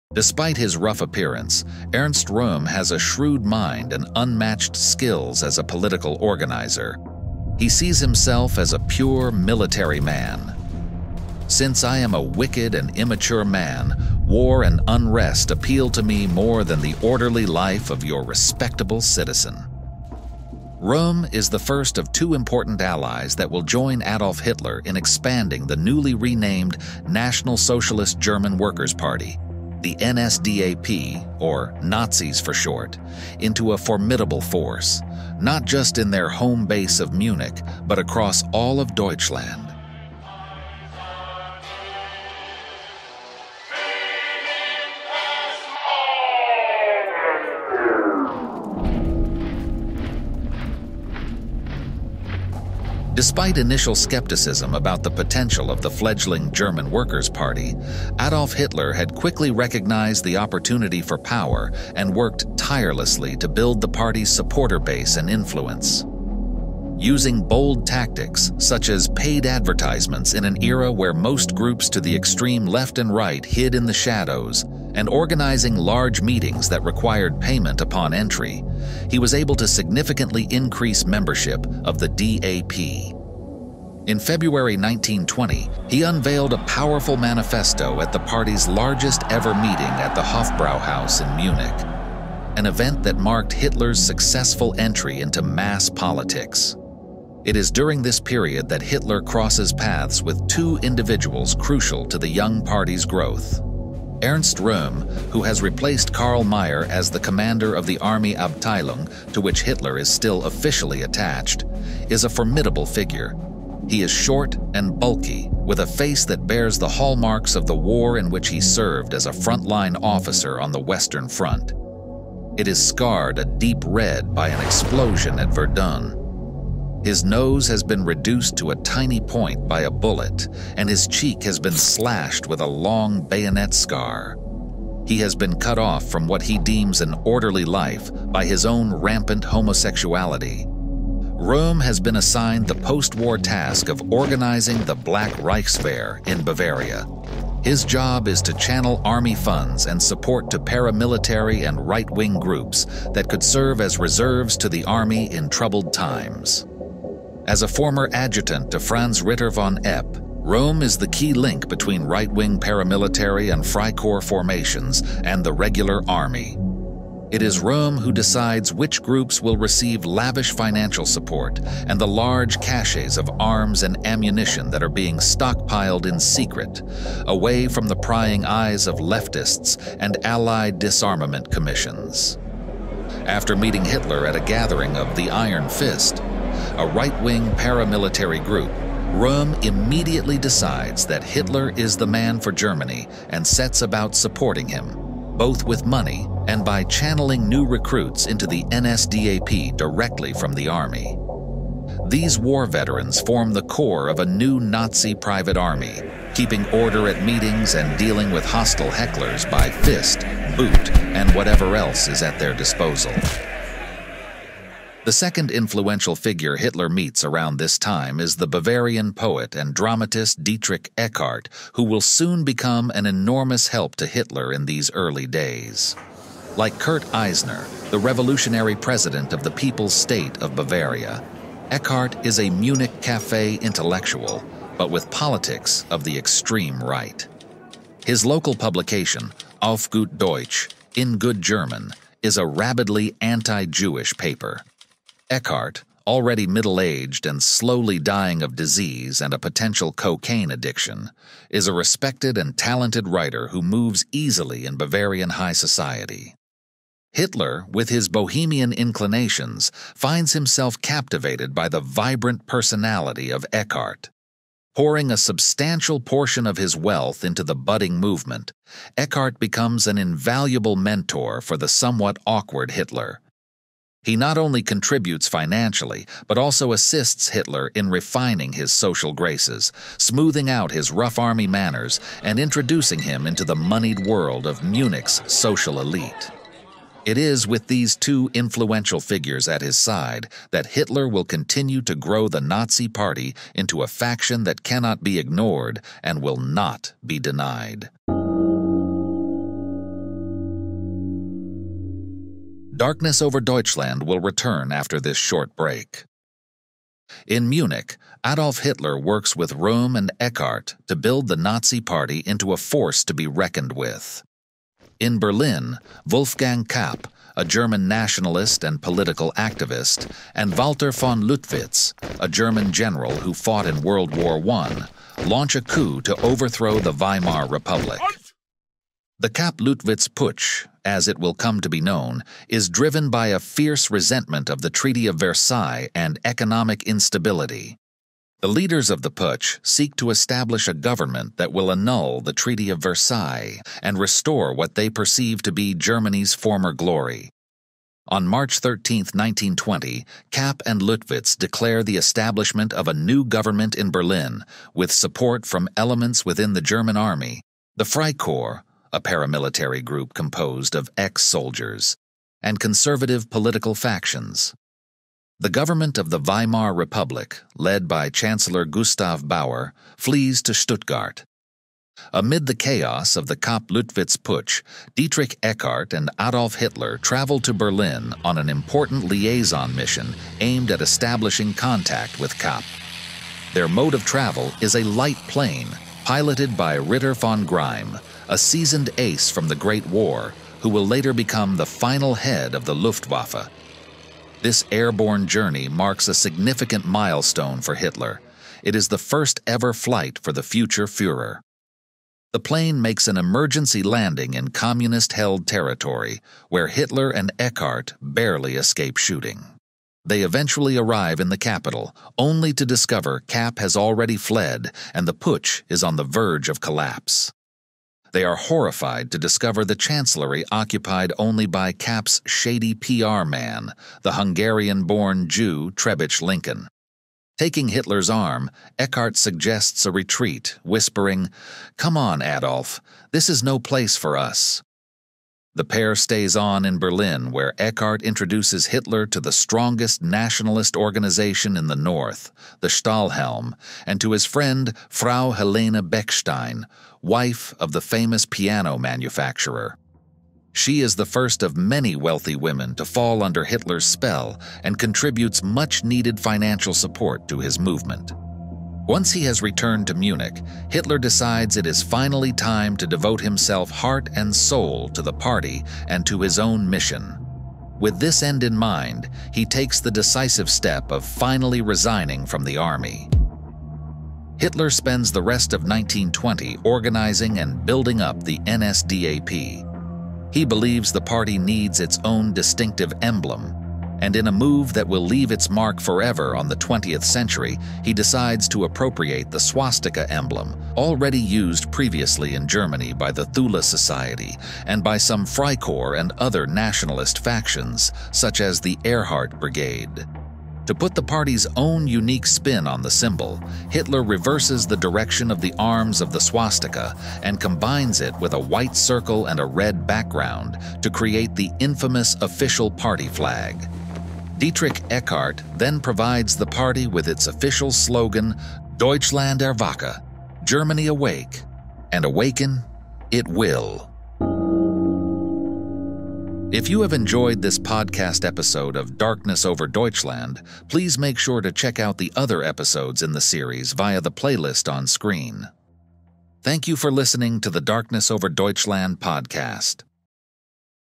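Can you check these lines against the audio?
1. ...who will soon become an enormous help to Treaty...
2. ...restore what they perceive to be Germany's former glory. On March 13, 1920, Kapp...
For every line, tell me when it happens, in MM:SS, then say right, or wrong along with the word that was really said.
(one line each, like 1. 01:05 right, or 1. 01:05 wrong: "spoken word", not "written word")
1. 03:41 wrong: "Hitler", not "Treaty"
2. 05:43 right.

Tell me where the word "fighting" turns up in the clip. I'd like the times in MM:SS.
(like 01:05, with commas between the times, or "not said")
not said.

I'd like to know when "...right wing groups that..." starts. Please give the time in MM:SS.
02:31.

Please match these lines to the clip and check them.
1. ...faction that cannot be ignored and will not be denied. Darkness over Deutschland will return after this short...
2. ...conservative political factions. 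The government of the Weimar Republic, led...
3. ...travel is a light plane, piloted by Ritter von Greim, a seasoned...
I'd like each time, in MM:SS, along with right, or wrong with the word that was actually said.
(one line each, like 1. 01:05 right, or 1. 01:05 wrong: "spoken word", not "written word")
1. 04:53 right
2. 06:02 right
3. 06:24 right.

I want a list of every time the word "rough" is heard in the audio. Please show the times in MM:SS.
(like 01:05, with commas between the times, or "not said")
00:00, 04:40.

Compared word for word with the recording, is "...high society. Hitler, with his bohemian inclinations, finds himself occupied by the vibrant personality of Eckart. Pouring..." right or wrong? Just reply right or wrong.
wrong.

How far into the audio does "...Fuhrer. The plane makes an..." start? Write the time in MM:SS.
06:40.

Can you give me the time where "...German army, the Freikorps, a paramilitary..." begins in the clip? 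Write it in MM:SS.
05:56.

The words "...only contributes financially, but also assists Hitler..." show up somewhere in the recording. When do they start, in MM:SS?
04:34.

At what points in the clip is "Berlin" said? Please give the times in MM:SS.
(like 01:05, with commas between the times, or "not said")
05:15, 05:53, 06:17, 07:16.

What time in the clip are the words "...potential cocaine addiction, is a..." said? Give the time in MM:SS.
04:09.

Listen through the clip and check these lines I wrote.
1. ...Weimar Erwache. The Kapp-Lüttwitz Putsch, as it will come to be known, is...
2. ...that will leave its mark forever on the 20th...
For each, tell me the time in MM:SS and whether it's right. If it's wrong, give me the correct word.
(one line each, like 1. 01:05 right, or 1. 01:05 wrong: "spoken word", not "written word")
1. 05:26 wrong: "Republic", not "Erwache"
2. 08:04 right.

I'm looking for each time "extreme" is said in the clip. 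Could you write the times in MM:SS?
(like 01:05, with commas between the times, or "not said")
01:12, 03:56.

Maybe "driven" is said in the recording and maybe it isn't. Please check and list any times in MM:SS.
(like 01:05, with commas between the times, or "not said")
05:32.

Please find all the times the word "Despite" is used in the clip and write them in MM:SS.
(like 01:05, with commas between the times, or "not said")
00:00, 00:53.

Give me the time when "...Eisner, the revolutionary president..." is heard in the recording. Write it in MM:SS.
03:47.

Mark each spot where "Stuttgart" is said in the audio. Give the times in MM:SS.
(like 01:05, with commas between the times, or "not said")
06:10.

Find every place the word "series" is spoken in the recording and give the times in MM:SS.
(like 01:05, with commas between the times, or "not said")
08:53.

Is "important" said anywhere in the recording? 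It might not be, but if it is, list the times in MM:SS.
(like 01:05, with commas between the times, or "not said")
00:22, 06:18.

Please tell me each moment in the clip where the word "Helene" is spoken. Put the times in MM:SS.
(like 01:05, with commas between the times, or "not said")
07:25.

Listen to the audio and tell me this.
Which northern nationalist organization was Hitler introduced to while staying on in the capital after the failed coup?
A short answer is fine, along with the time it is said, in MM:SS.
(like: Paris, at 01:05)
Stahlhelm, at 07:22.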